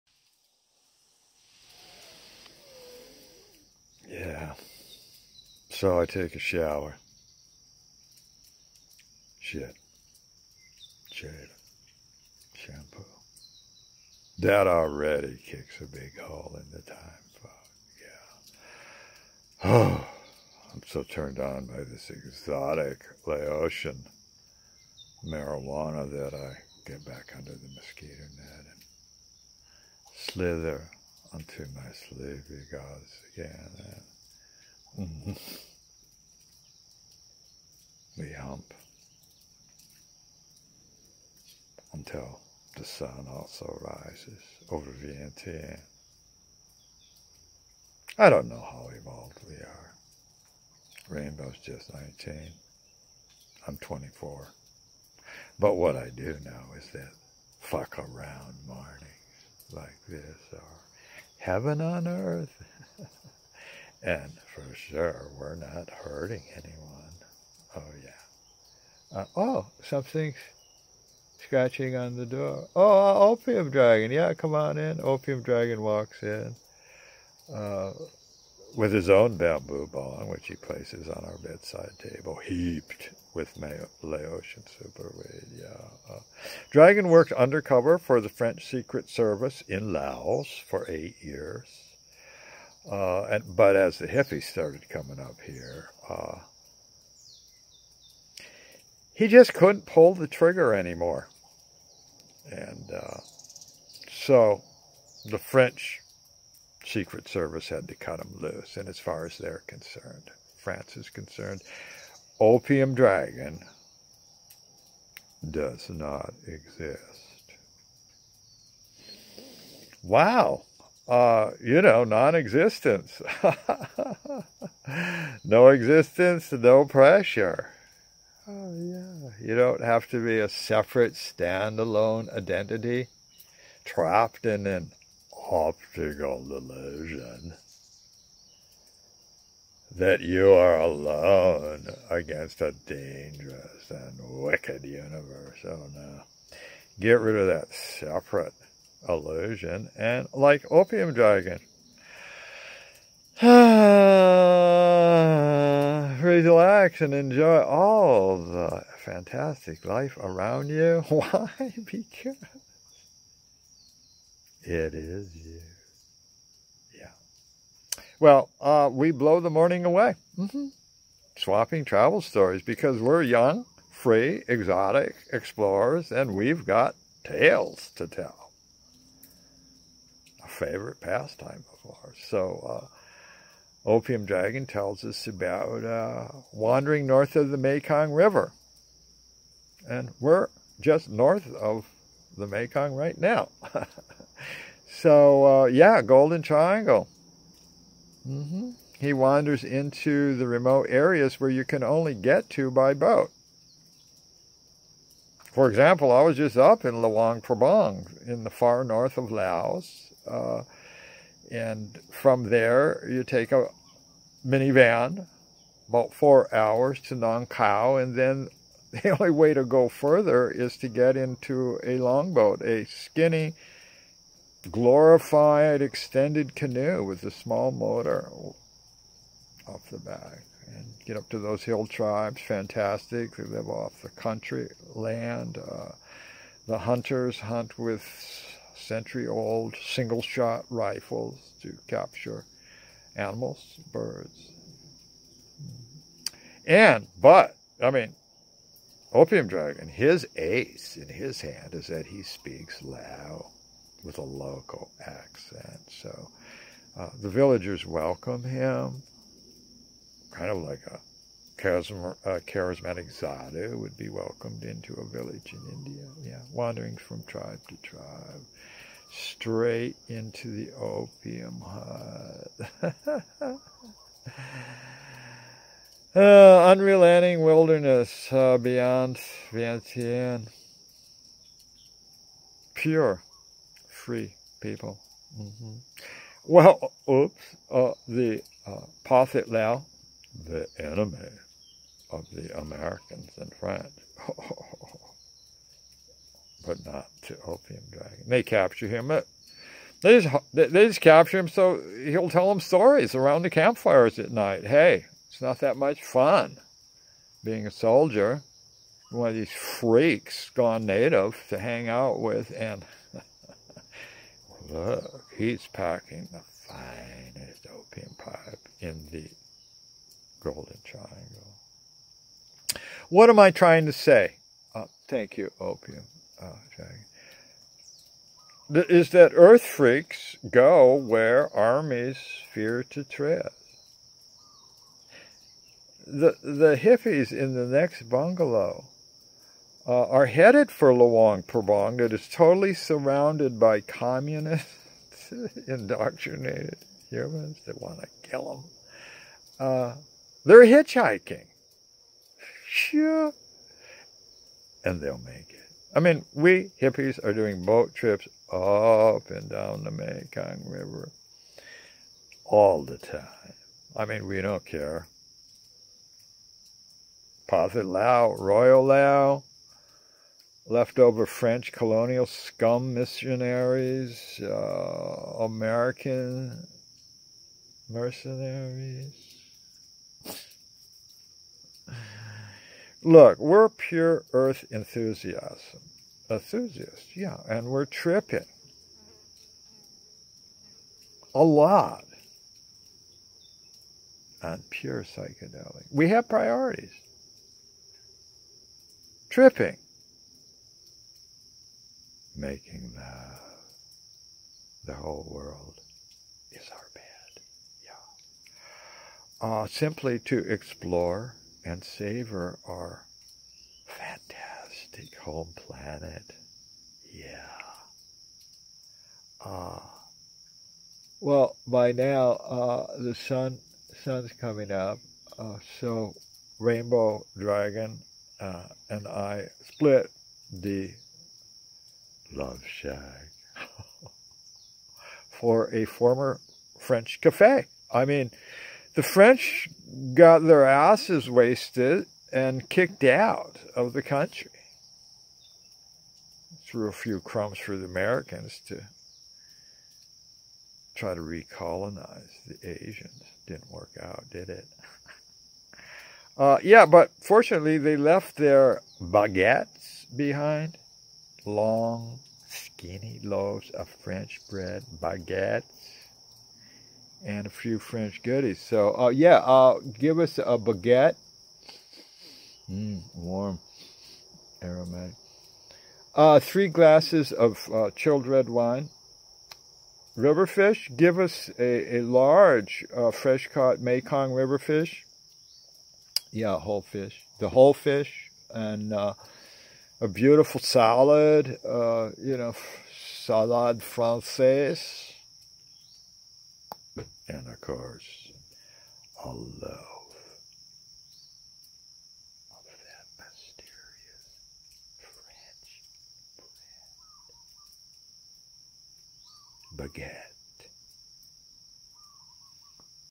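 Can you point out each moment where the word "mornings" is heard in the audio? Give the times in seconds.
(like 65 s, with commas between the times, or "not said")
58 s, 169 s.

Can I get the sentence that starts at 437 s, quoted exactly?
I mean, the French got their asses wasted and kicked out of the country.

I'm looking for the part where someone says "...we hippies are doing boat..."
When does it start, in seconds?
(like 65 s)
356 s.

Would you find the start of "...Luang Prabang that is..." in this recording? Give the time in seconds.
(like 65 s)
340 s.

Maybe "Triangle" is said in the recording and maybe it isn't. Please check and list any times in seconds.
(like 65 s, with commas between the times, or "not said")
196 s, 320 s.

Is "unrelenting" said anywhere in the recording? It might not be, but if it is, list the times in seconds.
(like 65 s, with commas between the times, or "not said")
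276 s.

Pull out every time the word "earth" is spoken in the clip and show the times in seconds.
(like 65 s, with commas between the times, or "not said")
62 s, 329 s, 384 s.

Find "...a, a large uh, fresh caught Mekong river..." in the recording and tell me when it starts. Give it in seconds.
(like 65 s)
481 s.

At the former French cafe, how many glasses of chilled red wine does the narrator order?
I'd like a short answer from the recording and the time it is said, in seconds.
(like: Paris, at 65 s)
3, at 476 s.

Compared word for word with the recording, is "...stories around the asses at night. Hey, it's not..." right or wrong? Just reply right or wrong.
wrong.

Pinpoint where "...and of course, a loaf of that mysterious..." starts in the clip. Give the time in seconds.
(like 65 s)
497 s.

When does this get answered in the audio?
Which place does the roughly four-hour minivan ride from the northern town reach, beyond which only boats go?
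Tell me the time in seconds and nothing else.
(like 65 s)
217 s.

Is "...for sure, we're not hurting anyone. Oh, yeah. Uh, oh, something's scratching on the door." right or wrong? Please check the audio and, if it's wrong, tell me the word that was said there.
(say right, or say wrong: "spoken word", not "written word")
right.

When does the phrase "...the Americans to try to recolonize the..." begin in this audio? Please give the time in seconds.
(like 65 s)
447 s.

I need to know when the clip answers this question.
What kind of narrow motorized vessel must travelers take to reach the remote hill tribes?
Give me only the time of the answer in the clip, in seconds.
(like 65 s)
221 s.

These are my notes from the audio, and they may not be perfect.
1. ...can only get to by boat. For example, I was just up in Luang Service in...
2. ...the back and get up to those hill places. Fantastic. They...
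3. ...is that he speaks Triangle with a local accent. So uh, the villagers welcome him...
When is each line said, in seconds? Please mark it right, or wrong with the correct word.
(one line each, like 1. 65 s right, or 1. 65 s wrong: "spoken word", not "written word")
1. 201 s wrong: "Prabang", not "Service"
2. 229 s wrong: "tribes", not "places"
3. 251 s wrong: "Lao", not "Triangle".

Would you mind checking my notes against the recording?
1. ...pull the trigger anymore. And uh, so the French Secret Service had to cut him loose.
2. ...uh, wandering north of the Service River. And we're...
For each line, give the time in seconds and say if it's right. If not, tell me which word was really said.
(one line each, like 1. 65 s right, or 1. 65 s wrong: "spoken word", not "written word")
1. 99 s right
2. 185 s wrong: "Mekong", not "Service".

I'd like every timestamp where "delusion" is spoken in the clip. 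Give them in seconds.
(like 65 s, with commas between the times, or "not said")
136 s.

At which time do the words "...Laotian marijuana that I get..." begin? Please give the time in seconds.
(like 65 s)
23 s.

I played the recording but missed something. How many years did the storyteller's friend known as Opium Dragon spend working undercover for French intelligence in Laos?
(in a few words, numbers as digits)
8.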